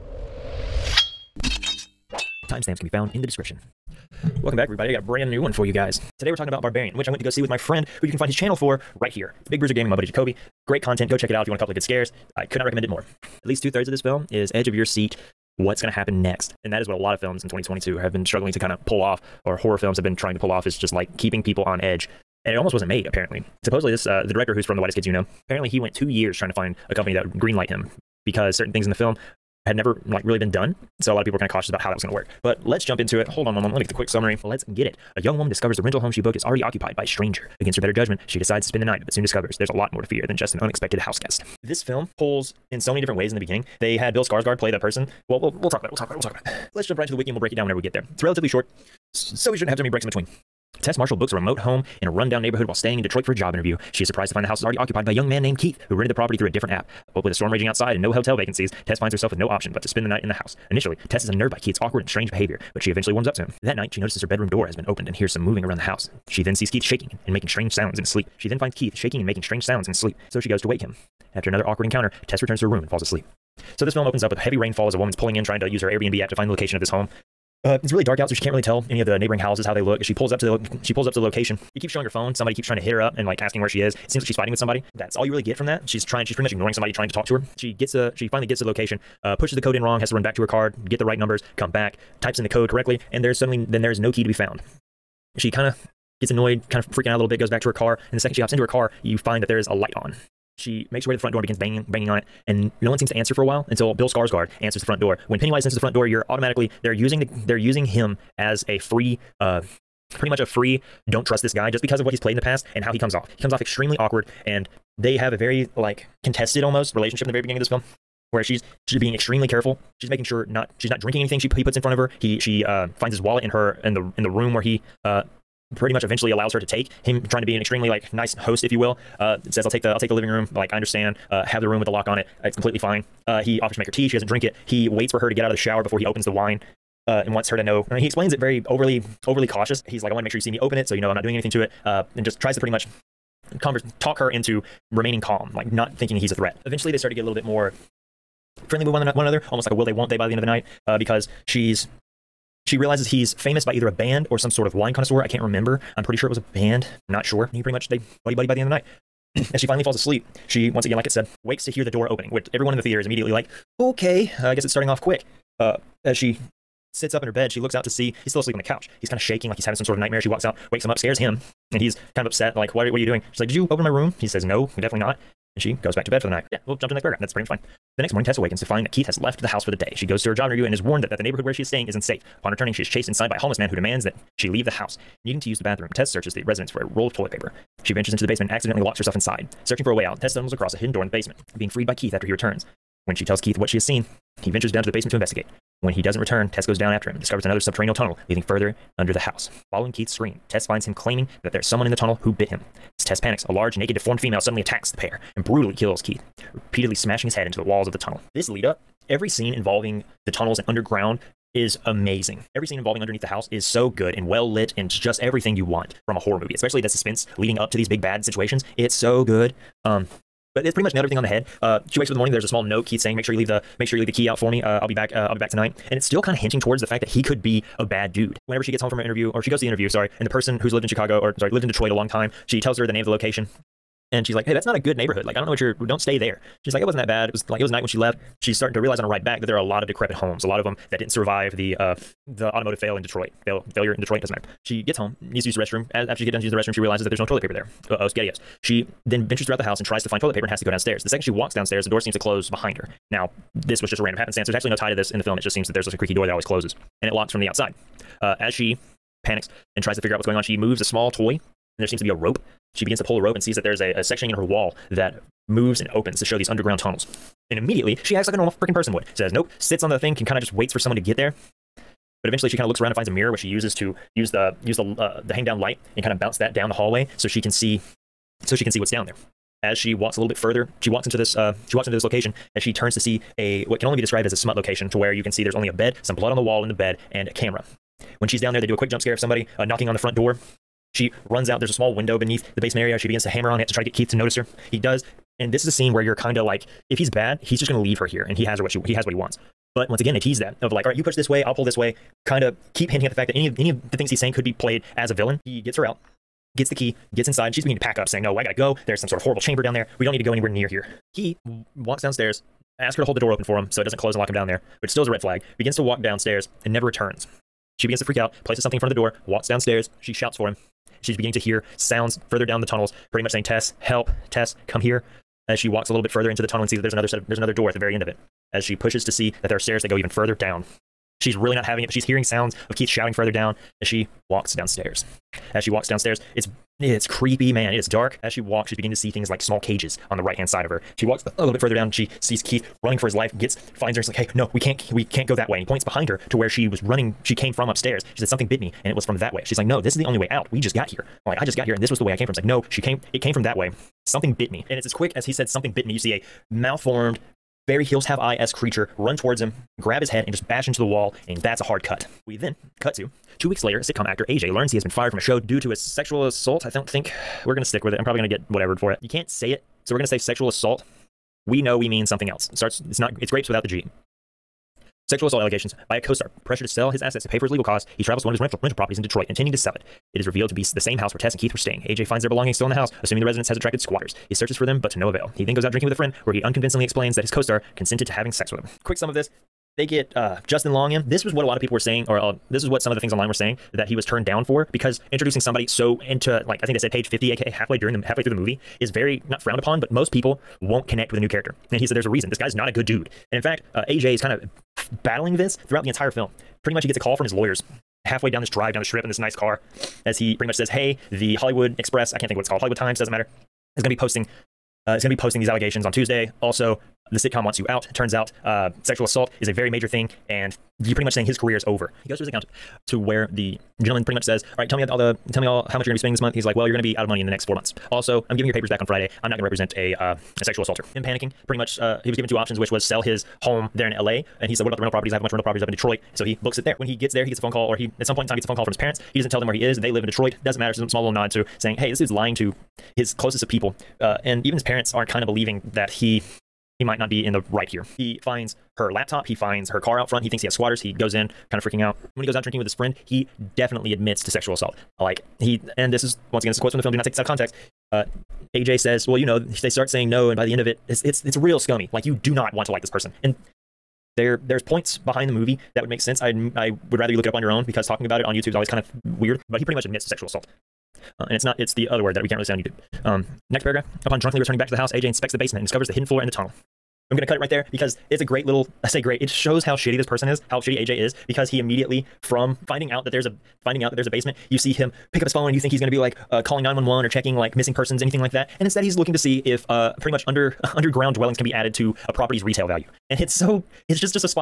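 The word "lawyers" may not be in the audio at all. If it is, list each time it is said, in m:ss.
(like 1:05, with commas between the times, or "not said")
6:47.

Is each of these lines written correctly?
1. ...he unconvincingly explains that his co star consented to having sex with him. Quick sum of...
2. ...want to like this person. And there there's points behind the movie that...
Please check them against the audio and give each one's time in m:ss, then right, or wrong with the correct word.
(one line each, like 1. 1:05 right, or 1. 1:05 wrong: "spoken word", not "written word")
1. 6:26 right
2. 7:42 right.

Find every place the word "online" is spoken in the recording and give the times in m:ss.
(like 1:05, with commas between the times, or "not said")
6:33.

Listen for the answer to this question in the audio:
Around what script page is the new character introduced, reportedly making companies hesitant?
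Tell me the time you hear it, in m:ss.
6:36.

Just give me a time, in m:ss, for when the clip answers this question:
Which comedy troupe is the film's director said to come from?
0:24.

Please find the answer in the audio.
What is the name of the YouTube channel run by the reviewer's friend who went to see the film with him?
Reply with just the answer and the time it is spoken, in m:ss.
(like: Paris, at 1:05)
Big Bruiser Gaming, at 0:09.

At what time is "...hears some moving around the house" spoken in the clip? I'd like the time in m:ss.
1:05.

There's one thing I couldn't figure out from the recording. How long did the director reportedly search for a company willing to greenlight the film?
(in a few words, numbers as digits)
2 years.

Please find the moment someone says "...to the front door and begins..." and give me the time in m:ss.
1:41.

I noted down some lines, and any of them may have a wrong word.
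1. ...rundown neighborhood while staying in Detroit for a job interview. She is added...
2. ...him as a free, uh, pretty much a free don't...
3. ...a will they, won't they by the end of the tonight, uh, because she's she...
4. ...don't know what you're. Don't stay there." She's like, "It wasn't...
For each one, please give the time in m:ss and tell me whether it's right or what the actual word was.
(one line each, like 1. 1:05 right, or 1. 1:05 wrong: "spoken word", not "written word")
1. 0:52 wrong: "surprised", not "added"
2. 1:47 right
3. 2:29 wrong: "night", not "tonight"
4. 3:55 right.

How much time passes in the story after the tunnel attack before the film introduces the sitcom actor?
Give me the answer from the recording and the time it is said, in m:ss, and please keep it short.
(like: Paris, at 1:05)
2 weeks, at 6:03.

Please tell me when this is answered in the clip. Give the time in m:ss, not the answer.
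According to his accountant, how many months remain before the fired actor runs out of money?
7:07.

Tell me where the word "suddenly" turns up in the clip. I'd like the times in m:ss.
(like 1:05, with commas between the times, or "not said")
1:33, 3:24.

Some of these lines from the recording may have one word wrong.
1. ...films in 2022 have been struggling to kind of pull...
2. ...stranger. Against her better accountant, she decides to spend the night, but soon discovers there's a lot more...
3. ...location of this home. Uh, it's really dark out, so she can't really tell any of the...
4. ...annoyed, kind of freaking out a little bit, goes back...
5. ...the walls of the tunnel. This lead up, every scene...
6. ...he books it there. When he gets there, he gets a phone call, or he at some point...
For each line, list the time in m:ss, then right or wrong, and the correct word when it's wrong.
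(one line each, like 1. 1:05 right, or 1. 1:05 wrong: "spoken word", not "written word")
1. 0:17 right
2. 0:37 wrong: "judgment", not "accountant"
3. 1:16 right
4. 1:36 right
5. 3:27 right
6. 7:16 right.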